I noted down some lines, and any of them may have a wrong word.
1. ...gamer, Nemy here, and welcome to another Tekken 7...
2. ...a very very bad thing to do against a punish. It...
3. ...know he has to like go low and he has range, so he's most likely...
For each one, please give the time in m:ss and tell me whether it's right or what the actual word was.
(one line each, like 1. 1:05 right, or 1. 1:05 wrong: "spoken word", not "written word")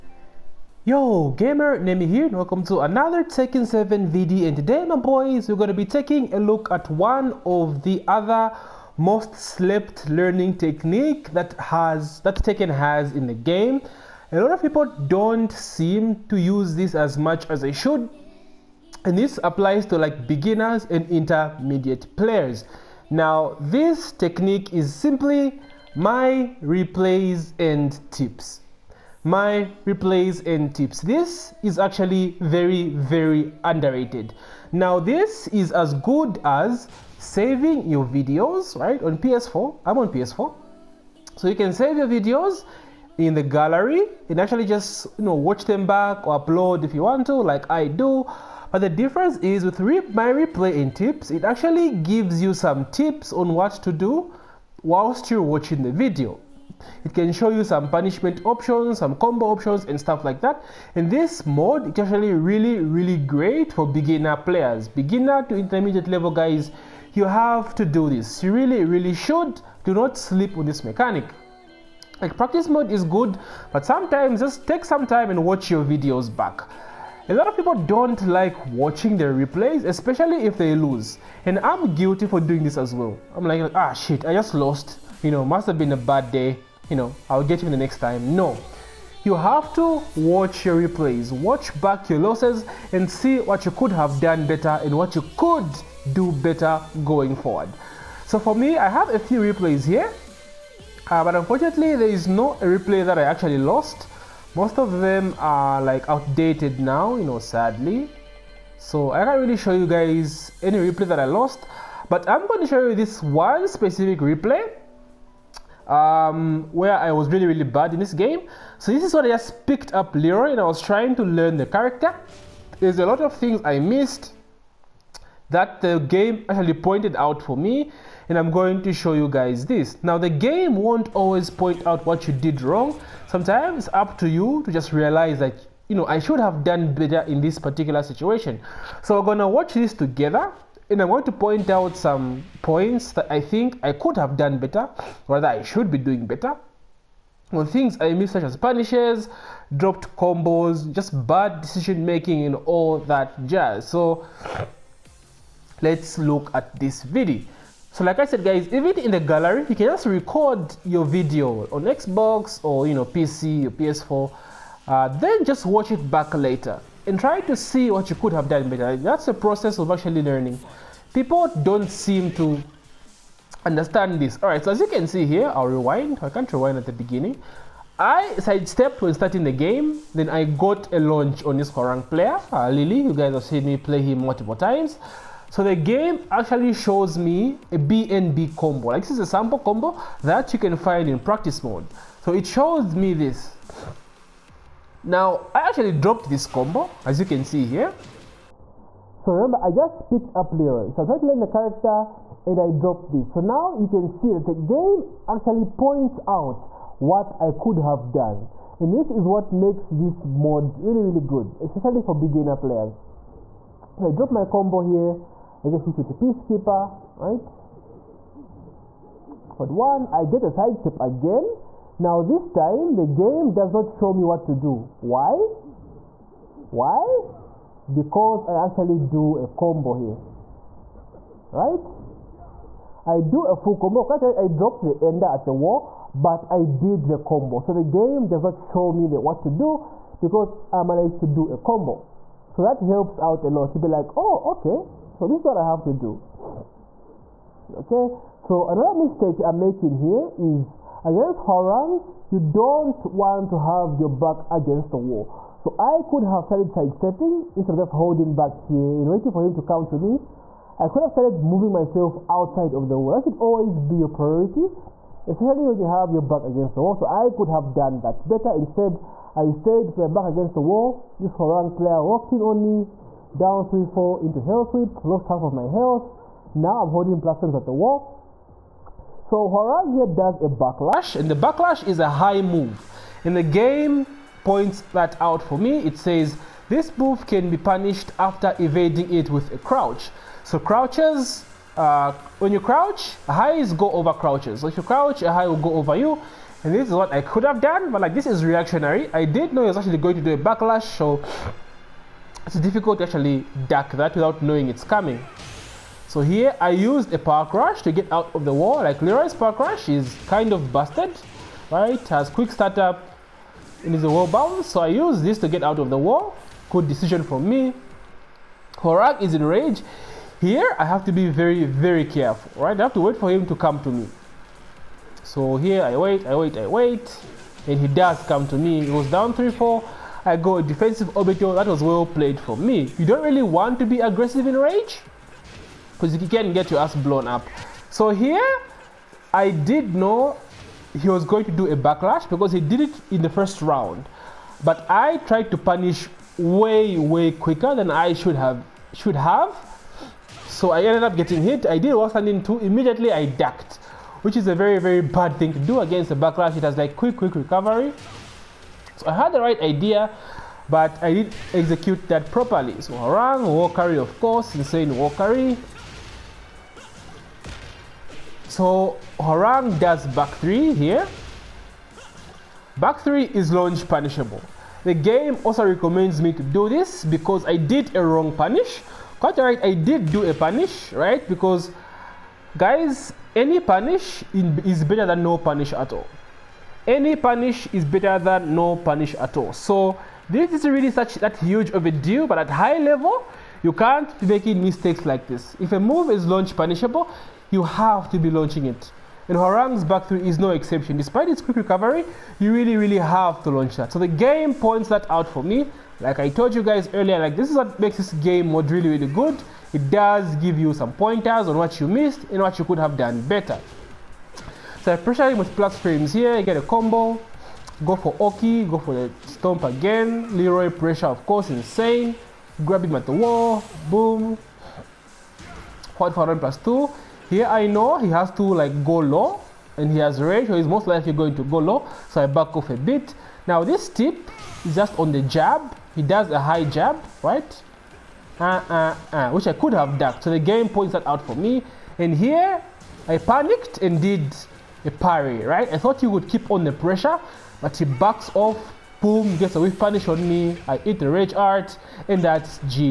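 1. 0:01 right
2. 5:54 wrong: "backlash", not "punish"
3. 7:07 right.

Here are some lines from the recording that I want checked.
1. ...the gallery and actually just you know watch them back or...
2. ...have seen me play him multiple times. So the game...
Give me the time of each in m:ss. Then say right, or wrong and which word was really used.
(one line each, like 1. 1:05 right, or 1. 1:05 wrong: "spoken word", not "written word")
1. 0:43 right
2. 3:03 right.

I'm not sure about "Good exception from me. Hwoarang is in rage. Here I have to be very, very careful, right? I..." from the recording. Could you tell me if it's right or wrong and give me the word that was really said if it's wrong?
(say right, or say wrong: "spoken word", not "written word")
wrong: "decision", not "exception".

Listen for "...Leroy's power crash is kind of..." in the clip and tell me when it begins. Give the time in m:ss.
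5:09.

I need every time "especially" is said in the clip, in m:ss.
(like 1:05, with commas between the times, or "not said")
1:19, 3:31, 4:25.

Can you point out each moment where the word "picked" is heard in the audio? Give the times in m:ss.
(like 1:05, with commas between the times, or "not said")
1:59, 3:20.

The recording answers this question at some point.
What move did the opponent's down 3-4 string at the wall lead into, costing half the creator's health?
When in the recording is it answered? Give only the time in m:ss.
4:34.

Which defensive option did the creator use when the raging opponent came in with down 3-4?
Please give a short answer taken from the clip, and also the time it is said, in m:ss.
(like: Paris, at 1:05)
Defensive orbital, at 5:30.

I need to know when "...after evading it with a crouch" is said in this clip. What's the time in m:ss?
4:48.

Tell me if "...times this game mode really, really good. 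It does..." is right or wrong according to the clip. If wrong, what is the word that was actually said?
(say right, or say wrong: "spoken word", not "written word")
wrong: "makes", not "times".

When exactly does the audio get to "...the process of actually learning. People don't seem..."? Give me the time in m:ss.
2:49.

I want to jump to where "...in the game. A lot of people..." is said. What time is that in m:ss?
0:13.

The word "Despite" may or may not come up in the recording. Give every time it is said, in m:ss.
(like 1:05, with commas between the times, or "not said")
6:40.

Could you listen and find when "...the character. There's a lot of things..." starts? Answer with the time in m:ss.
2:01.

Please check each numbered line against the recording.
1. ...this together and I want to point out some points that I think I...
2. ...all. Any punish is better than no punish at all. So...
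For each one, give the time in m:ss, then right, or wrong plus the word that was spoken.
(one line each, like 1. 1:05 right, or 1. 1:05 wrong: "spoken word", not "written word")
1. 2:19 right
2. 6:25 right.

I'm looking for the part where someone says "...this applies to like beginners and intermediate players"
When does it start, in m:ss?
0:19.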